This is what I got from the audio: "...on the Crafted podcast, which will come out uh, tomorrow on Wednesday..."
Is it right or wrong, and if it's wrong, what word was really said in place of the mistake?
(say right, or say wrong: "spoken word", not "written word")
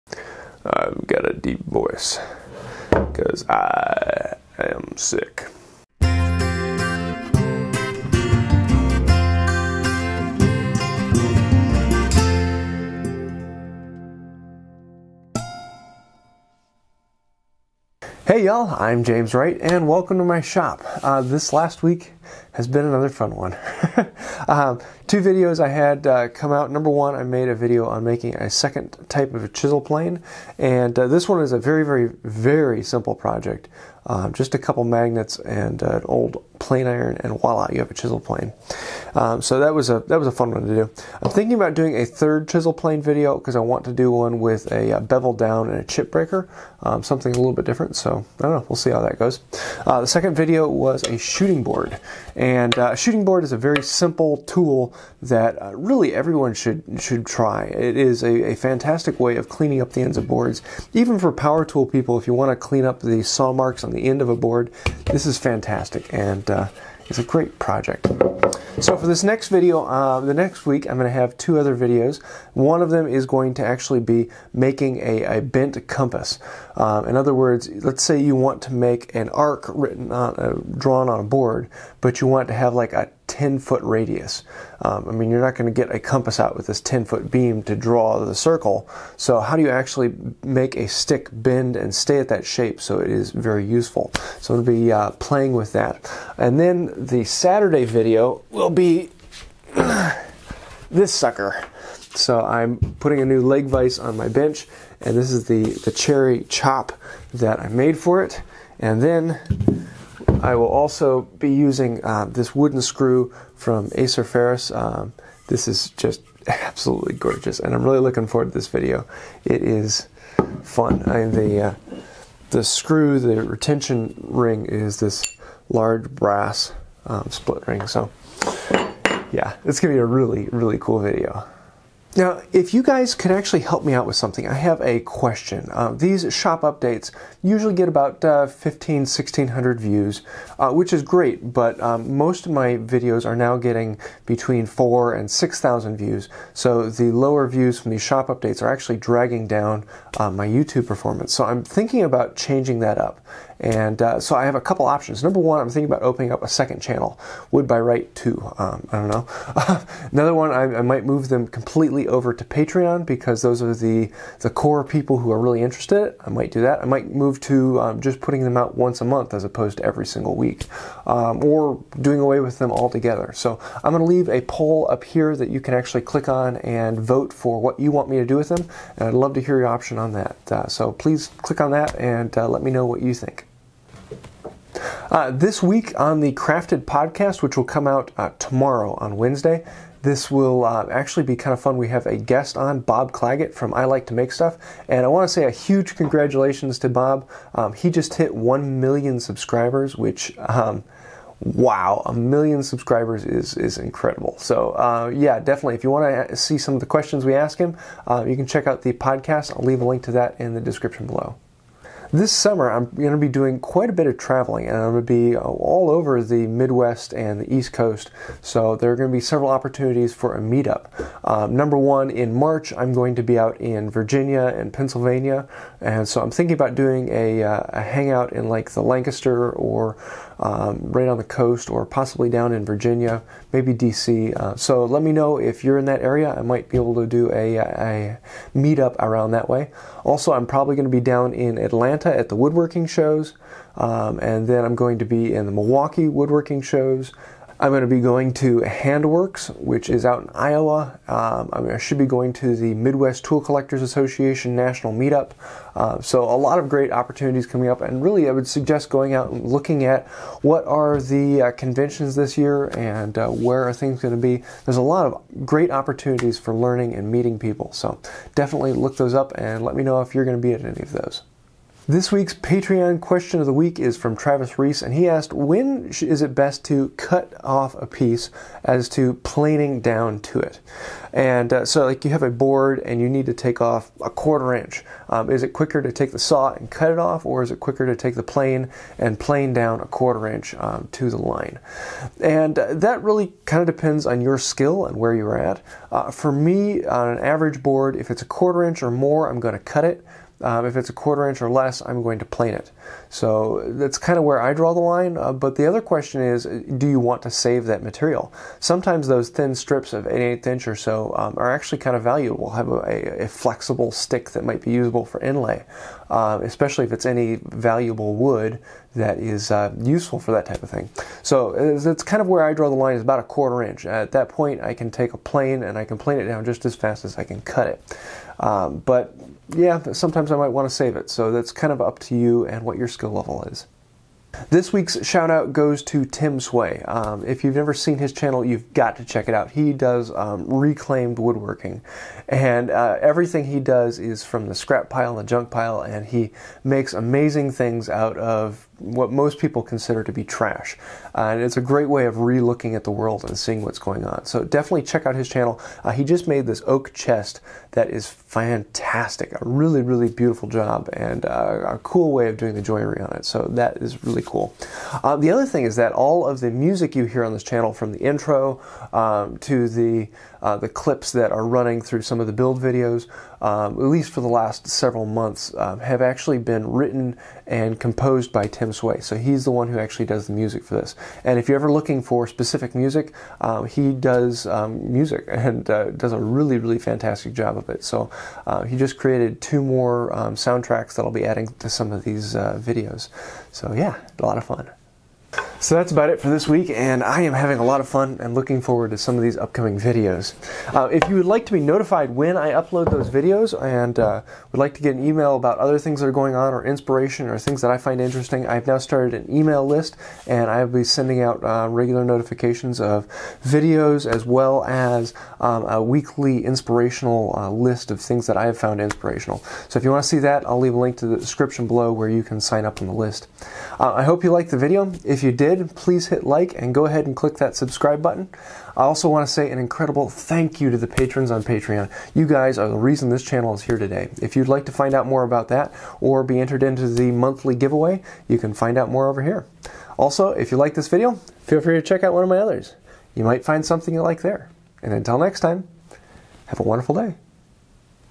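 right.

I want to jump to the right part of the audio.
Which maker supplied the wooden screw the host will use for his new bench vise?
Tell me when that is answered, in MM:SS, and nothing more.
01:53.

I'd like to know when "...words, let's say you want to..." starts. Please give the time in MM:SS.
01:17.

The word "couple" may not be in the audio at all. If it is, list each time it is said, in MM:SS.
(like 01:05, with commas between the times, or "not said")
00:34, 02:34.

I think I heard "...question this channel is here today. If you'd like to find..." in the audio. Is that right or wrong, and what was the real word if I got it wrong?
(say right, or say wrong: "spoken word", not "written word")
wrong: "reason", not "question".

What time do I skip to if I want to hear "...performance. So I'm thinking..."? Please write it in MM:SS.
02:30.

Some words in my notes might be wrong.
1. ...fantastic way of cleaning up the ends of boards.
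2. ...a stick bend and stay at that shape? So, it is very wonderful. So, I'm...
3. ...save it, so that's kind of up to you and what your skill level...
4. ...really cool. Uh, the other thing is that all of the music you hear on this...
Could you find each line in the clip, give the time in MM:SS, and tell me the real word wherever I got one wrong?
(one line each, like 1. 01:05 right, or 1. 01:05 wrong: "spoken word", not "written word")
1. 00:58 right
2. 01:30 wrong: "useful", not "wonderful"
3. 05:30 right
4. 06:04 right.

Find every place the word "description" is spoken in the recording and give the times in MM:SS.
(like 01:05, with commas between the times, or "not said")
03:30, 07:01.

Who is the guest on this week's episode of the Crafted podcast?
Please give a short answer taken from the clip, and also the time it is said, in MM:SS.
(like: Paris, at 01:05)
Bob Clagett, at 03:12.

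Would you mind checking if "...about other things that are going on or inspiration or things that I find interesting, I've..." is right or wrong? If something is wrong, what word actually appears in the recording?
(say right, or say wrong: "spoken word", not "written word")
right.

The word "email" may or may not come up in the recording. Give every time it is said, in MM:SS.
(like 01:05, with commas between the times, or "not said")
06:45, 06:49.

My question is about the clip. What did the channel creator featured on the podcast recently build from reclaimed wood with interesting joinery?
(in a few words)
Oak chest.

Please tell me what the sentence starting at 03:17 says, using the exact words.
Um, he just hit 1 million subscribers, which.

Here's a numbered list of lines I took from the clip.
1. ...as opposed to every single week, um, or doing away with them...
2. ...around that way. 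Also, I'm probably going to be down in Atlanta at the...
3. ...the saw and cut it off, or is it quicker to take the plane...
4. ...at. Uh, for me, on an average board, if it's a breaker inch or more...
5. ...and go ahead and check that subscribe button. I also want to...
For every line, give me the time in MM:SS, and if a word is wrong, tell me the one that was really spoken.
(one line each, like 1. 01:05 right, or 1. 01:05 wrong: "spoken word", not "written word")
1. 02:49 right
2. 03:58 right
3. 04:46 right
4. 04:55 wrong: "quarter", not "breaker"
5. 07:06 wrong: "click", not "check".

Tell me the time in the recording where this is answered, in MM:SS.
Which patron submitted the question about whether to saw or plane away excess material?
04:34.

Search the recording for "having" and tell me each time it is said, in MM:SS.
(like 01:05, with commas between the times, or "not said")
06:37.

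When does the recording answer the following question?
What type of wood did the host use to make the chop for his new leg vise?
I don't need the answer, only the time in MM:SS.
01:45.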